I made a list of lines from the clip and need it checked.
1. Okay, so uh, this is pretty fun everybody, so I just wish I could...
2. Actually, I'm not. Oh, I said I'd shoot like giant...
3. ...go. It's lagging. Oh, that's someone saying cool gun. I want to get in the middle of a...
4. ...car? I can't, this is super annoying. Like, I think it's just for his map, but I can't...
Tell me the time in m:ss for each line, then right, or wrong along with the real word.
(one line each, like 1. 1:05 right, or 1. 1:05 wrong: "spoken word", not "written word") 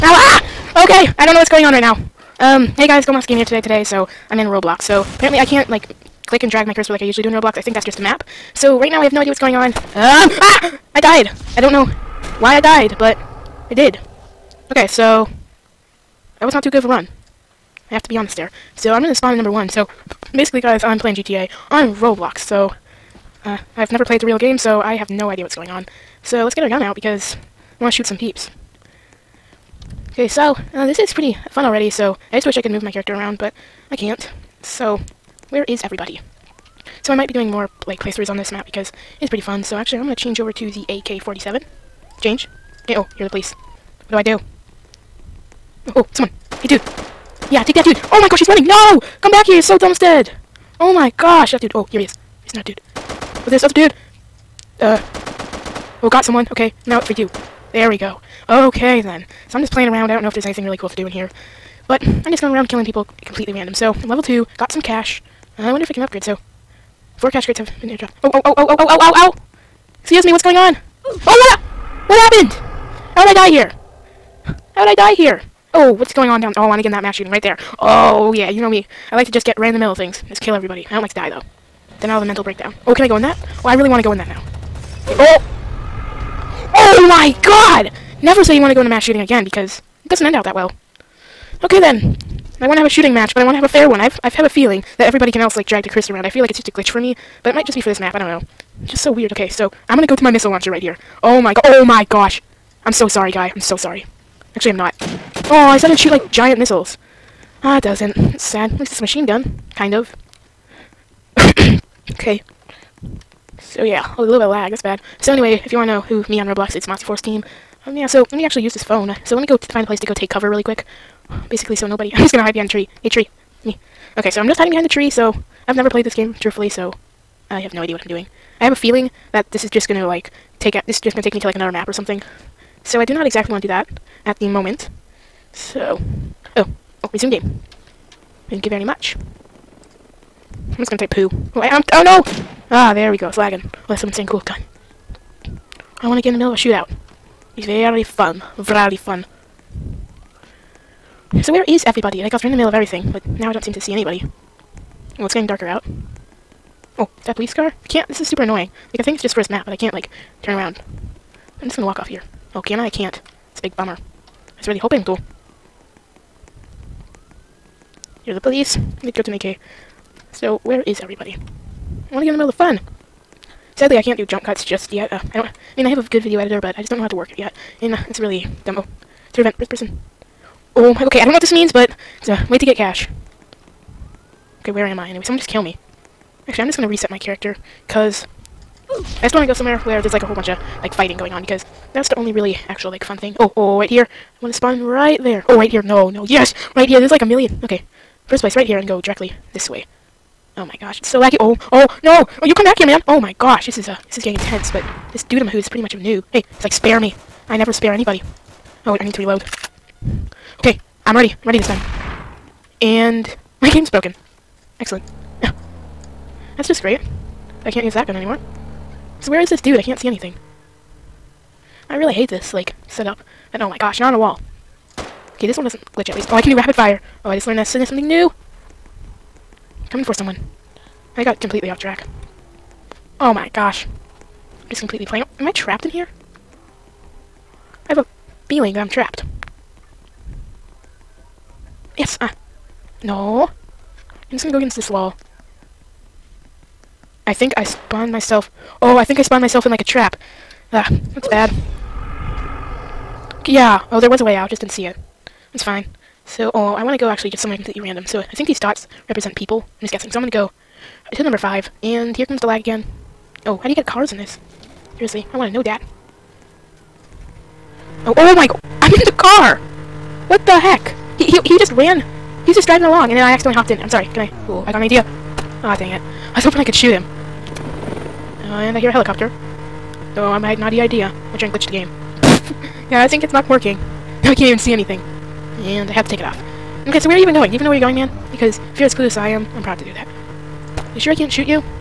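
1. 0:30 wrong: "already", not "everybody"
2. 1:44 right
3. 2:23 right
4. 2:37 right.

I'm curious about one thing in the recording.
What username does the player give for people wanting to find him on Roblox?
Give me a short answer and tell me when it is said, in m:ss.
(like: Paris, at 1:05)
Motsy Force Team, at 1:56.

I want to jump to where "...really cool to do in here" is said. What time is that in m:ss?
1:00.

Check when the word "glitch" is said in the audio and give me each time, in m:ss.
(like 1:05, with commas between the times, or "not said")
1:36, 3:45, 4:41.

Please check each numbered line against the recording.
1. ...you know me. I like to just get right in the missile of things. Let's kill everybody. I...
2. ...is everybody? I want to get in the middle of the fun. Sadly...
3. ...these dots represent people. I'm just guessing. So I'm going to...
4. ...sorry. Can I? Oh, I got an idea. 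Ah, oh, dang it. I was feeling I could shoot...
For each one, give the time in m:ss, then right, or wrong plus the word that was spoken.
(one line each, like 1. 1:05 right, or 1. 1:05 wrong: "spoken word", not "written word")
1. 1:18 wrong: "middle", not "missile"
2. 2:50 right
3. 4:18 right
4. 4:33 wrong: "hoping", not "feeling".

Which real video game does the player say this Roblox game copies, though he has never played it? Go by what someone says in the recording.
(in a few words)
GTA.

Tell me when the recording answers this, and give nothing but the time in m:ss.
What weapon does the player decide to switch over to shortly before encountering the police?
0:40.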